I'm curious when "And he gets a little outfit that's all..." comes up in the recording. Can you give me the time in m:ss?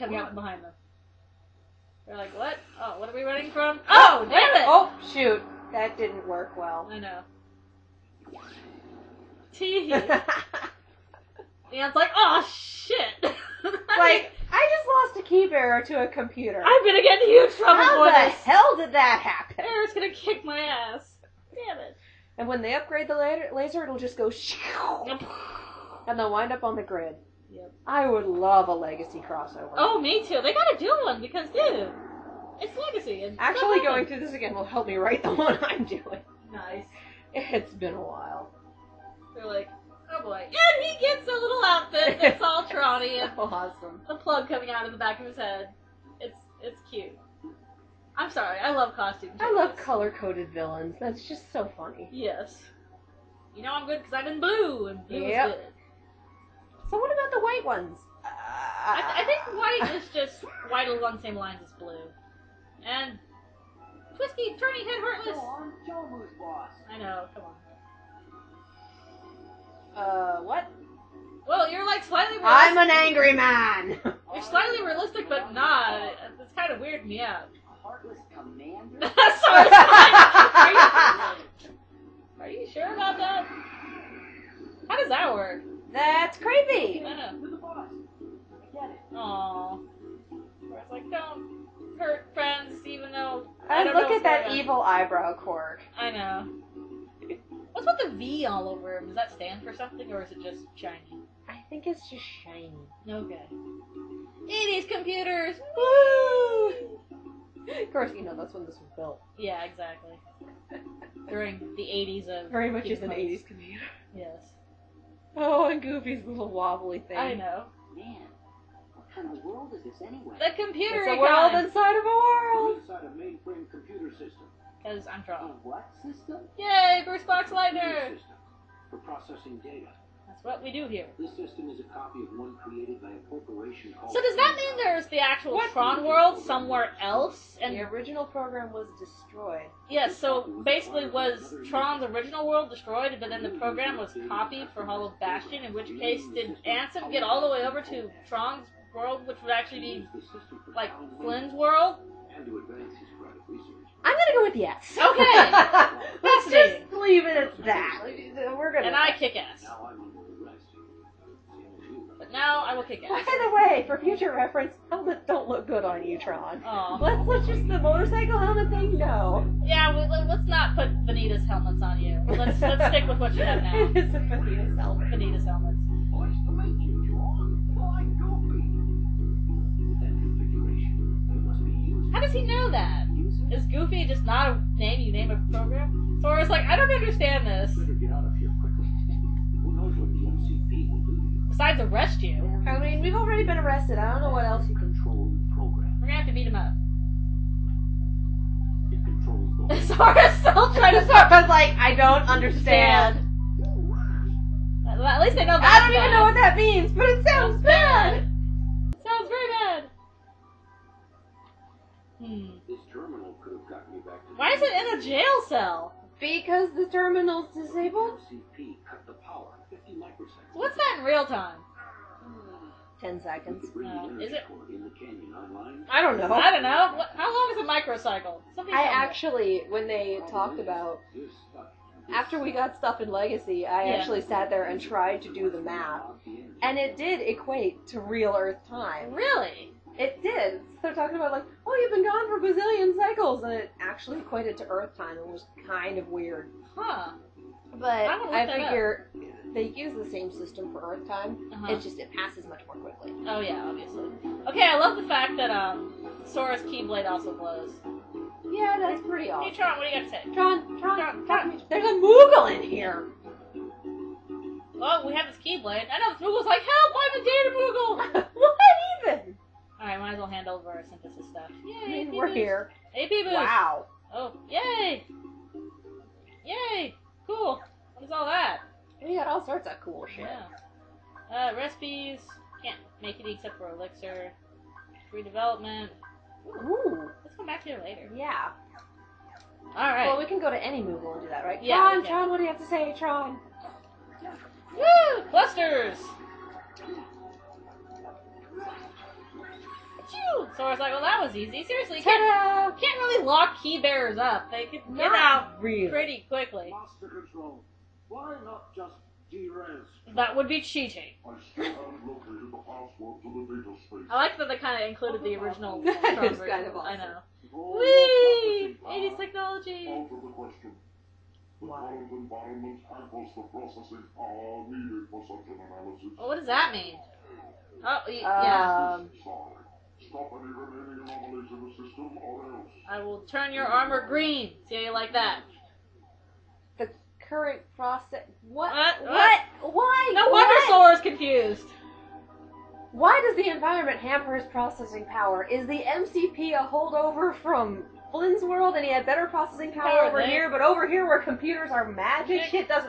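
0:40.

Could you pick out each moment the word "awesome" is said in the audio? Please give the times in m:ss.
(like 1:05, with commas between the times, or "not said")
0:43, 4:19, 5:16.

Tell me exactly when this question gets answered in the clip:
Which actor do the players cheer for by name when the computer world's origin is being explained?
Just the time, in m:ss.
2:07.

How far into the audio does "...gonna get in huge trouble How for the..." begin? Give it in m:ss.
0:16.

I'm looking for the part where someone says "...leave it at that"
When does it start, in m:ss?
2:36.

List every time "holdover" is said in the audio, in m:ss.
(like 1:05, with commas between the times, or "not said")
5:46.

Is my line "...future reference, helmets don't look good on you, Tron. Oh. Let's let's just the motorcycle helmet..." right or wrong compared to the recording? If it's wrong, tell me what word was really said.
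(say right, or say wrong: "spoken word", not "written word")
right.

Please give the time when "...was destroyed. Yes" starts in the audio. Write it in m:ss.
2:18.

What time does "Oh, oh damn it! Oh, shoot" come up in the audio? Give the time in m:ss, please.
0:03.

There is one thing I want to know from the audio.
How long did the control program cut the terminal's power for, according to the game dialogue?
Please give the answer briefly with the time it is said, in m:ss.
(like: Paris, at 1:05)
50 microseconds, at 3:39.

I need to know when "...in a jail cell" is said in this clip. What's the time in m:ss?
3:34.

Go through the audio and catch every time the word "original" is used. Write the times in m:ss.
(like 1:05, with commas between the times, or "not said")
2:17, 2:22, 5:15.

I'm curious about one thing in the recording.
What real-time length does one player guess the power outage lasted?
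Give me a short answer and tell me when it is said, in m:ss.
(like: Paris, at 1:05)
10 seconds, at 3:43.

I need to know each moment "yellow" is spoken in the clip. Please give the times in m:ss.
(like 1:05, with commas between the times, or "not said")
not said.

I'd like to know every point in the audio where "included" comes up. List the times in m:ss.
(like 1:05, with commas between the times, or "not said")
5:14.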